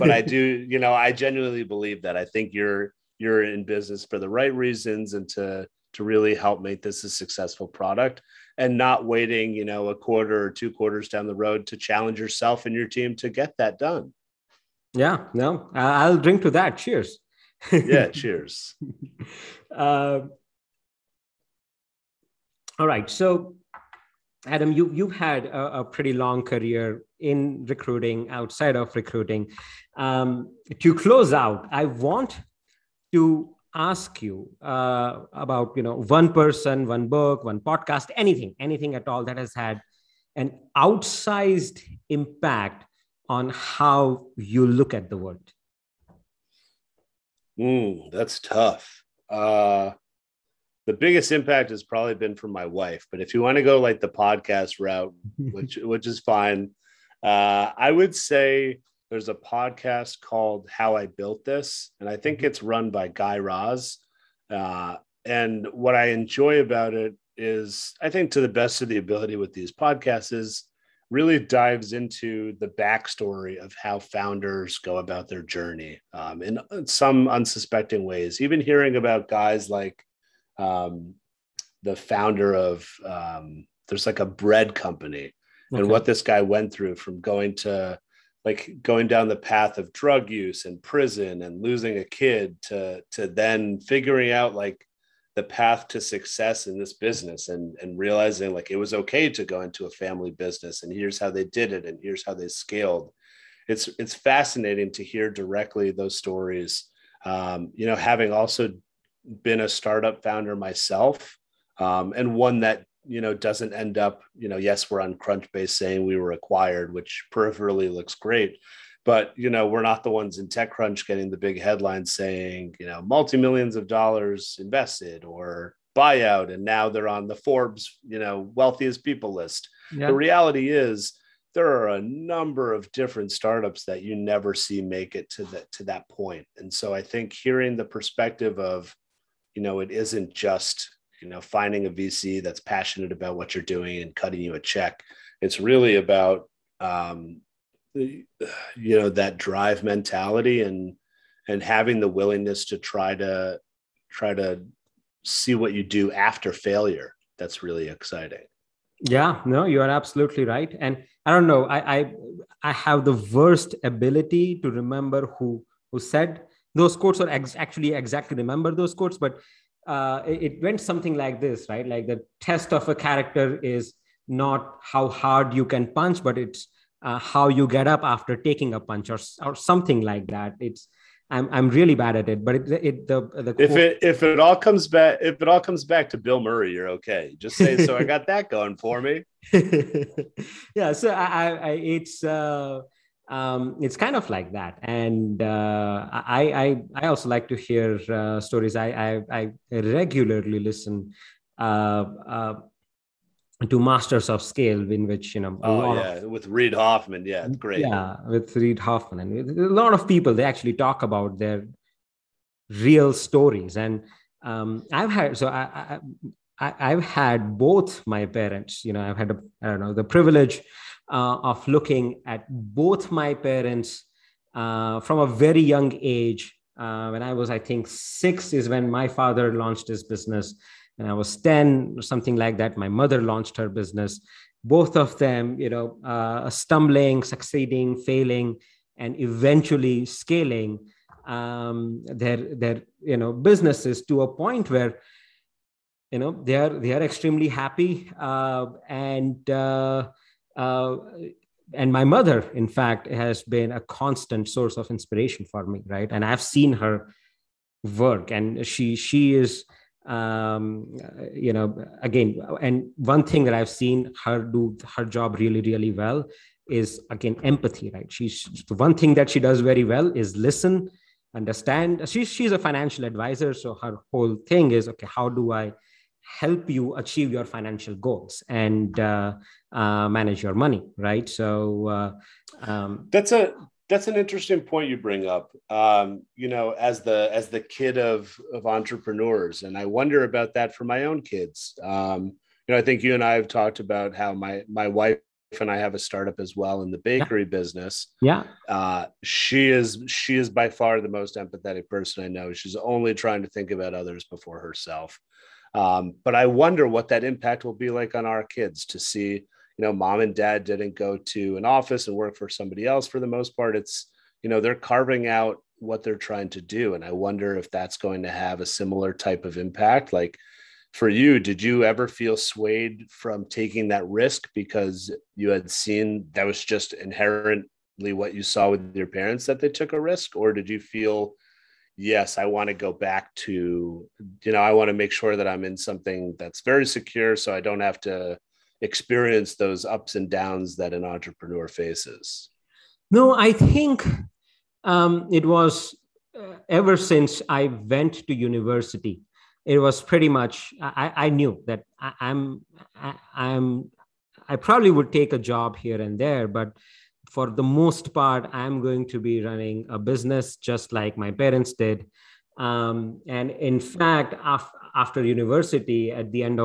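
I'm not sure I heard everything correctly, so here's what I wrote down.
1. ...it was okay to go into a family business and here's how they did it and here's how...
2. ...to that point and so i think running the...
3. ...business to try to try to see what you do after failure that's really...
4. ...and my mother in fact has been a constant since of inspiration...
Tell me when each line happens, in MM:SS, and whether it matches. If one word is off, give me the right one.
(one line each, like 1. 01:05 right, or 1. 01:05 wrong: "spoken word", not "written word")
1. 01:38 right
2. 02:15 wrong: "hearing", not "running"
3. 02:32 wrong: "willingness", not "business"
4. 04:11 wrong: "source", not "since".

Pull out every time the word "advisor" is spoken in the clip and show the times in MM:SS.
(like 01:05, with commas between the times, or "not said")
04:33.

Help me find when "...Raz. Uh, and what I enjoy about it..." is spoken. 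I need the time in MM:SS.
01:03.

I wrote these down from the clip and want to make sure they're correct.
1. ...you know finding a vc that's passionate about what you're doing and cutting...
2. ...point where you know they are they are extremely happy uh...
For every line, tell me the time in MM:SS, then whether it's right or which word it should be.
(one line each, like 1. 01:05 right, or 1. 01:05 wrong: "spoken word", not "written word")
1. 02:21 right
2. 04:04 right.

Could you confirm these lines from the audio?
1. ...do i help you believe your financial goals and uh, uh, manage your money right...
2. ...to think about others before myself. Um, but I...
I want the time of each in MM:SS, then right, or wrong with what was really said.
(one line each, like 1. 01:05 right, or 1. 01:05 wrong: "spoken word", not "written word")
1. 04:35 wrong: "achieve", not "believe"
2. 05:03 wrong: "herself", not "myself".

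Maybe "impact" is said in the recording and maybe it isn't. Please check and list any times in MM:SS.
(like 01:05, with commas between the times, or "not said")
00:42, 00:51, 05:07, 05:19.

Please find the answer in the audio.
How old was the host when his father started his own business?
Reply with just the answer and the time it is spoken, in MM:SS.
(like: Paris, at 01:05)
6, at 03:47.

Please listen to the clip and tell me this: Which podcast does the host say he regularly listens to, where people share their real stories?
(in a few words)
Masters of Scale.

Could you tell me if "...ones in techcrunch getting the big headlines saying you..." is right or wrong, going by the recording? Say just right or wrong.
right.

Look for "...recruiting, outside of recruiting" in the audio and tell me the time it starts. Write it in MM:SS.
00:27.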